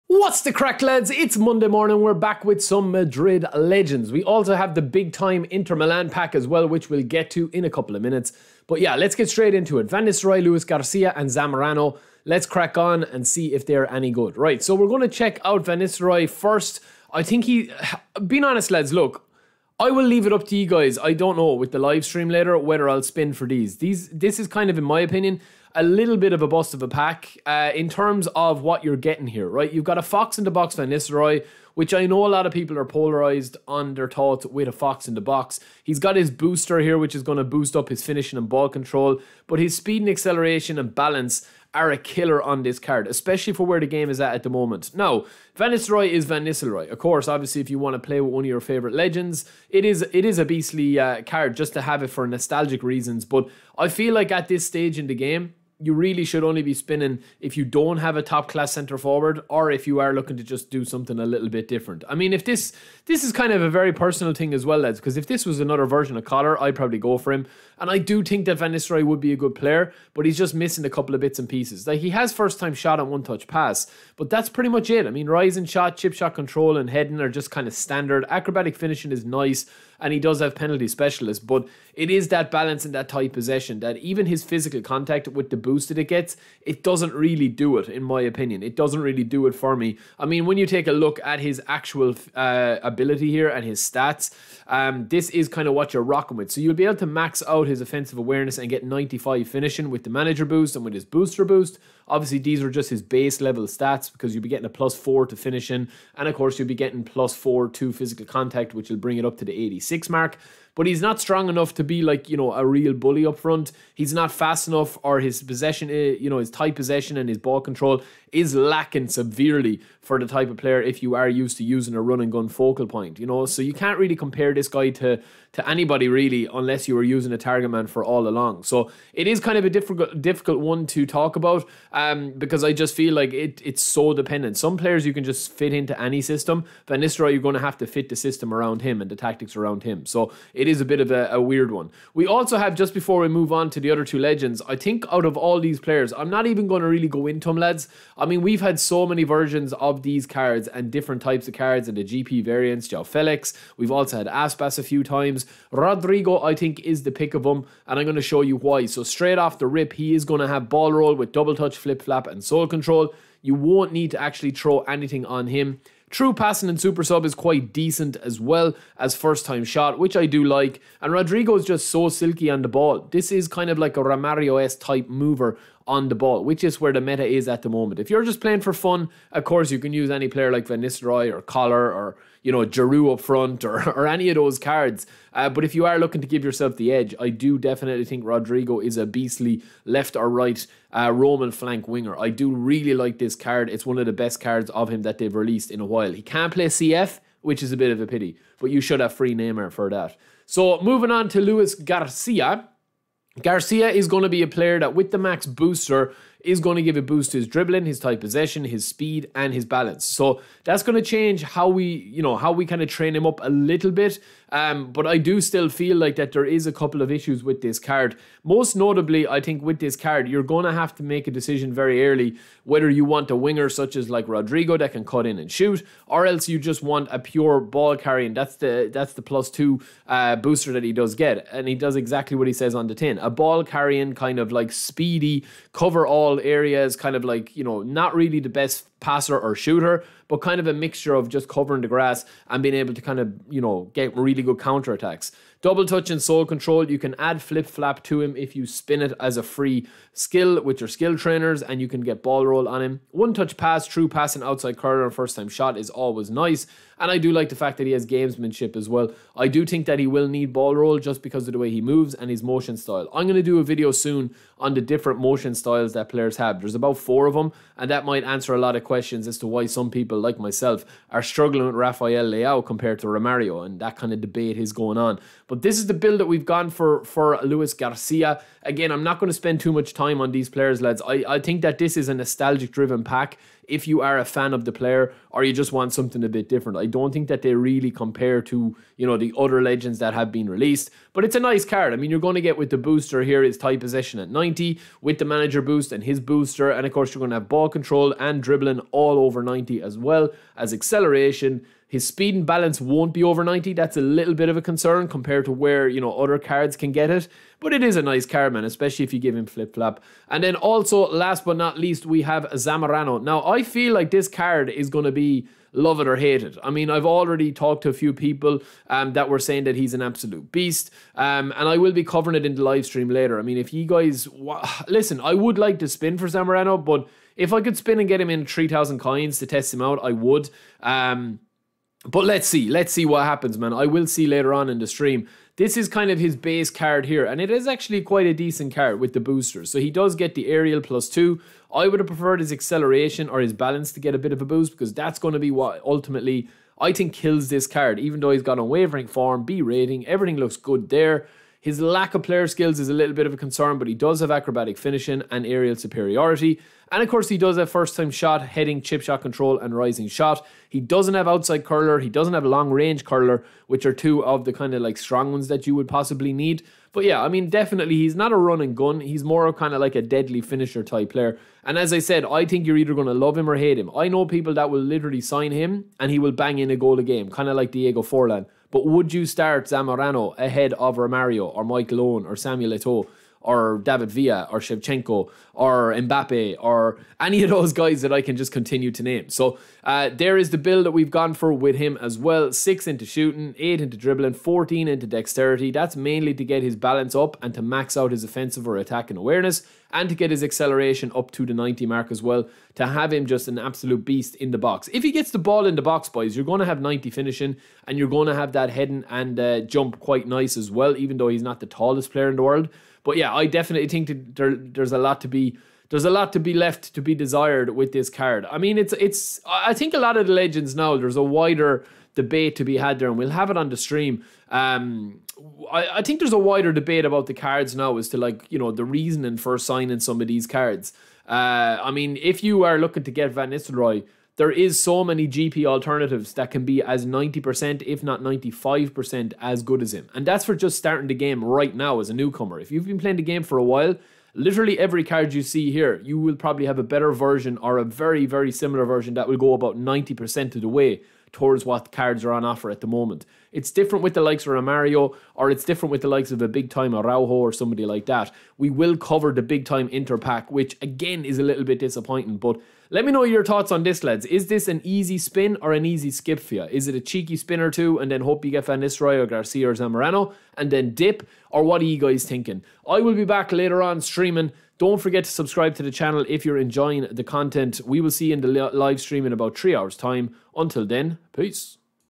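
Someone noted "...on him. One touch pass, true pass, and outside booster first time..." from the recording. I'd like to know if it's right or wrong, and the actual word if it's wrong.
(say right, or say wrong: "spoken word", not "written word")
wrong: "curler", not "booster".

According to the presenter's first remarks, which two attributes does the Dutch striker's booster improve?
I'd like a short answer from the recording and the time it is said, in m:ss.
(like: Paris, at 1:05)
finishing and ball control, at 0:38.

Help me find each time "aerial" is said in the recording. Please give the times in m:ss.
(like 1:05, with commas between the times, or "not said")
5:40, 5:55.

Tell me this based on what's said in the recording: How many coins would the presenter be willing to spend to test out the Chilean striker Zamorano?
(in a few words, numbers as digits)
3,000.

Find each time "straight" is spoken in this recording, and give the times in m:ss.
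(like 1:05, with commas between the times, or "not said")
0:09, 2:39.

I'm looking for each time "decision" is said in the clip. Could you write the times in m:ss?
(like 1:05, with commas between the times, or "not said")
3:41.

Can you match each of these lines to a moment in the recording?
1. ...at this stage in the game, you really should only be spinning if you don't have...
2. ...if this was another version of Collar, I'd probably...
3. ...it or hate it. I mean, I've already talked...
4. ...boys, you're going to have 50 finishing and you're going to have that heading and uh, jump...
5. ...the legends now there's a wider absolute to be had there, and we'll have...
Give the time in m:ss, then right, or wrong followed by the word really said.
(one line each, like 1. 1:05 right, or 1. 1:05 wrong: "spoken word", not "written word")
1. 0:54 right
2. 1:05 right
3. 5:15 right
4. 6:46 wrong: "90", not "50"
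5. 7:00 wrong: "debate", not "absolute".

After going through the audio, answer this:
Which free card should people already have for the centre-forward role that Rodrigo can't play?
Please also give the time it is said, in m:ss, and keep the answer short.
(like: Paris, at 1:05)
Neymar, at 3:19.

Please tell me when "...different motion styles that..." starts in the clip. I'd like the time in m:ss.
4:24.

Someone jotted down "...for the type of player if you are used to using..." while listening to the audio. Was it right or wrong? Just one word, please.
right.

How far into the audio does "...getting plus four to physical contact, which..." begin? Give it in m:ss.
1:46.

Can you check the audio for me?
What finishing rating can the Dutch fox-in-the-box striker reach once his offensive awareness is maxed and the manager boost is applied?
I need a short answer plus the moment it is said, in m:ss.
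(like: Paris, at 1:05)
95, at 1:38.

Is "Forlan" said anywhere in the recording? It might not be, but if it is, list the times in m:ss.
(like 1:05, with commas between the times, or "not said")
6:18.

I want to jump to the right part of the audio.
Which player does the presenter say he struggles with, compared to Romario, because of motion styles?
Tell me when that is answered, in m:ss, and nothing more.
4:31.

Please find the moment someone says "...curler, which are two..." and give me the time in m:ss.
6:03.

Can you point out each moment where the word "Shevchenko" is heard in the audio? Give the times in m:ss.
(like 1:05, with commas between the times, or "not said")
6:24.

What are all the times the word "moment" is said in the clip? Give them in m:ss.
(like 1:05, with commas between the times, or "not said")
0:44, 2:57, 7:32.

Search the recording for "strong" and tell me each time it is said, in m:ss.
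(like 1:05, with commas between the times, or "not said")
1:51, 6:04.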